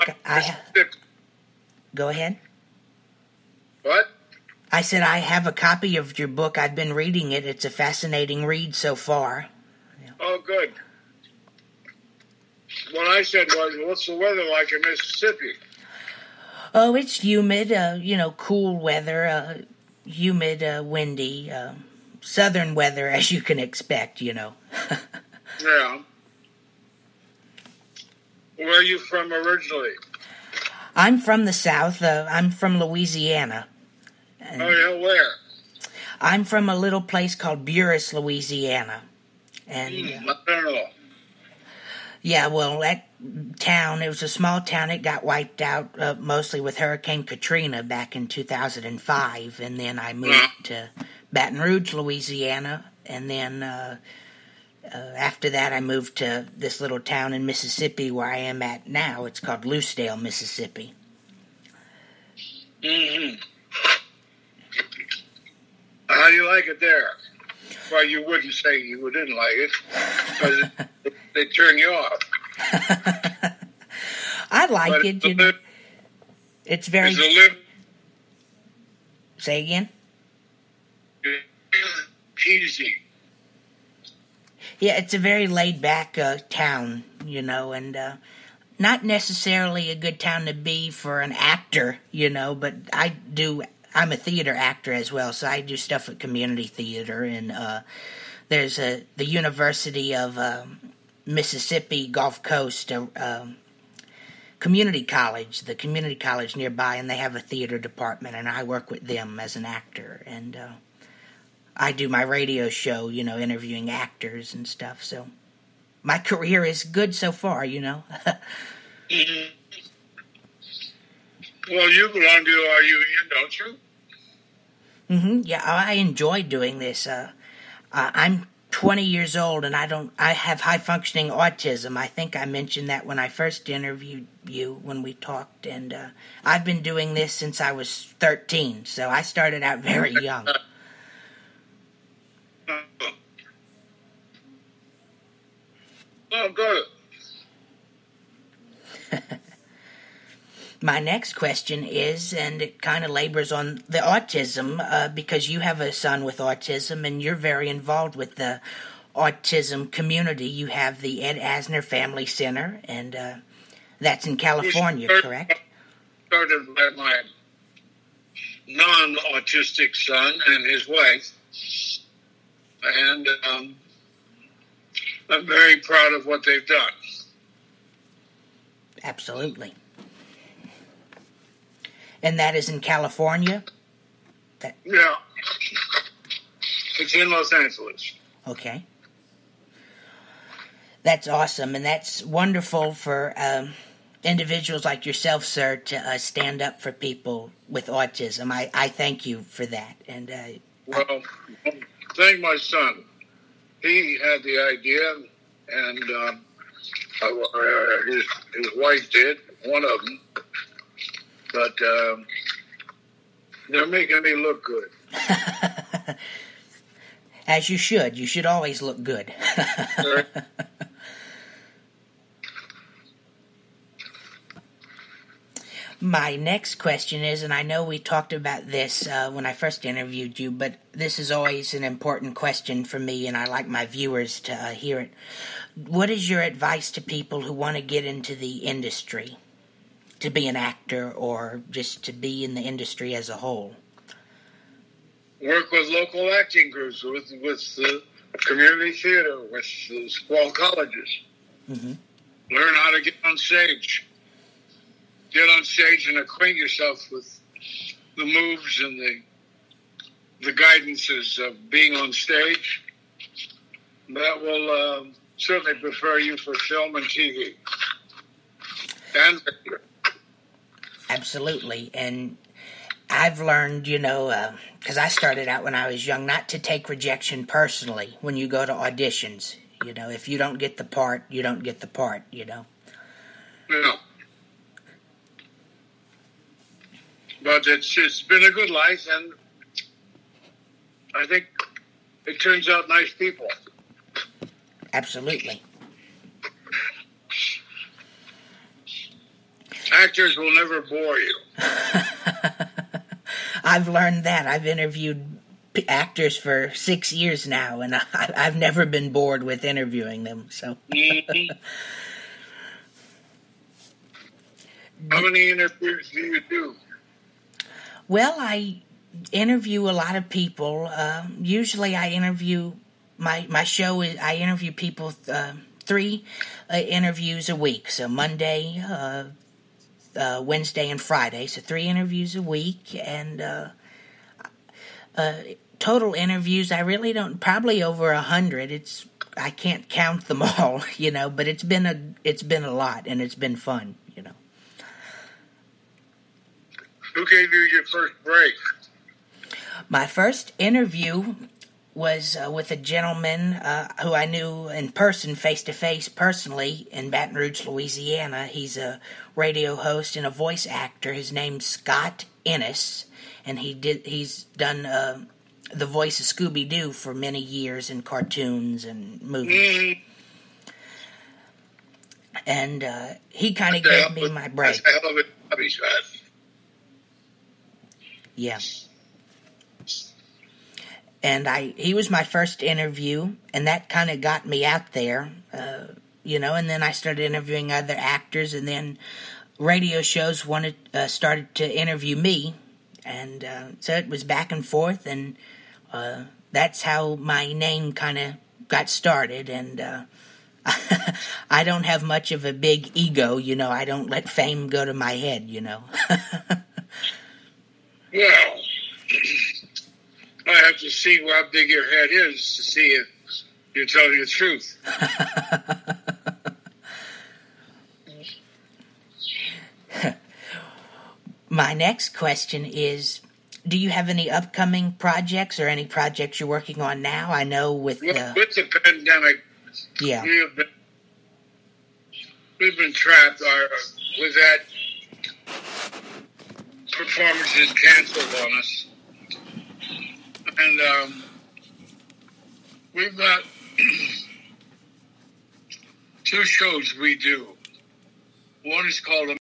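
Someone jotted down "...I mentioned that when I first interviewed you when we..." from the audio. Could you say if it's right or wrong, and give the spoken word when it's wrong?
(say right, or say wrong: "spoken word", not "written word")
right.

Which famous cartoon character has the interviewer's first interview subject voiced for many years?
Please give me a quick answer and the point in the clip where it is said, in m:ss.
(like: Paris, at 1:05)
Scooby Doo, at 6:06.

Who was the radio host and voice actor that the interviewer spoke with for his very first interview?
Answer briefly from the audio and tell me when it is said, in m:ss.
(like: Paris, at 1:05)
Scott Innes, at 6:01.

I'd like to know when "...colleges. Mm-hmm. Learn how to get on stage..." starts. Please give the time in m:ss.
4:10.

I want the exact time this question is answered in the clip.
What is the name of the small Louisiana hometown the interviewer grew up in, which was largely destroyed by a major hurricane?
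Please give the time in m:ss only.
0:37.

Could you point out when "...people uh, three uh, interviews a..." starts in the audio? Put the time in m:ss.
5:24.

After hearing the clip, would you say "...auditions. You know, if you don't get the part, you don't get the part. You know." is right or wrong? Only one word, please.
right.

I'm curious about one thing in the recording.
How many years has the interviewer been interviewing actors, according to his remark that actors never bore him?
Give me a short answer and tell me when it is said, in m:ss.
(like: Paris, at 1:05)
6, at 5:06.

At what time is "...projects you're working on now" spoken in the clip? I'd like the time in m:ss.
7:05.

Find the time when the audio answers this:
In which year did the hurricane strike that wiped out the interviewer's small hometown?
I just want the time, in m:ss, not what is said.
0:48.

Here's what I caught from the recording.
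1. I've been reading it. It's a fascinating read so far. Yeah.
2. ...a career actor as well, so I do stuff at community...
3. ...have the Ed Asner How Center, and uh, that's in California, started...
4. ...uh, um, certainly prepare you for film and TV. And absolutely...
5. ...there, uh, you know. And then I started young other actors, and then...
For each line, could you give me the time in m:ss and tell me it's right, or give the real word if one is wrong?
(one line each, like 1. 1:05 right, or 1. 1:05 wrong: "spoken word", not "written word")
1. 0:06 right
2. 1:34 wrong: "theater", not "career"
3. 2:40 wrong: "Family", not "How"
4. 4:24 right
5. 6:24 wrong: "interviewing", not "young".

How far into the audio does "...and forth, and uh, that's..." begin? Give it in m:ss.
6:34.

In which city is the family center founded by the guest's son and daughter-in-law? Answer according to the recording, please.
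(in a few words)
Los Angeles.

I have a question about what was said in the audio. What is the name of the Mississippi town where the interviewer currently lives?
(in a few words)
Lucedale.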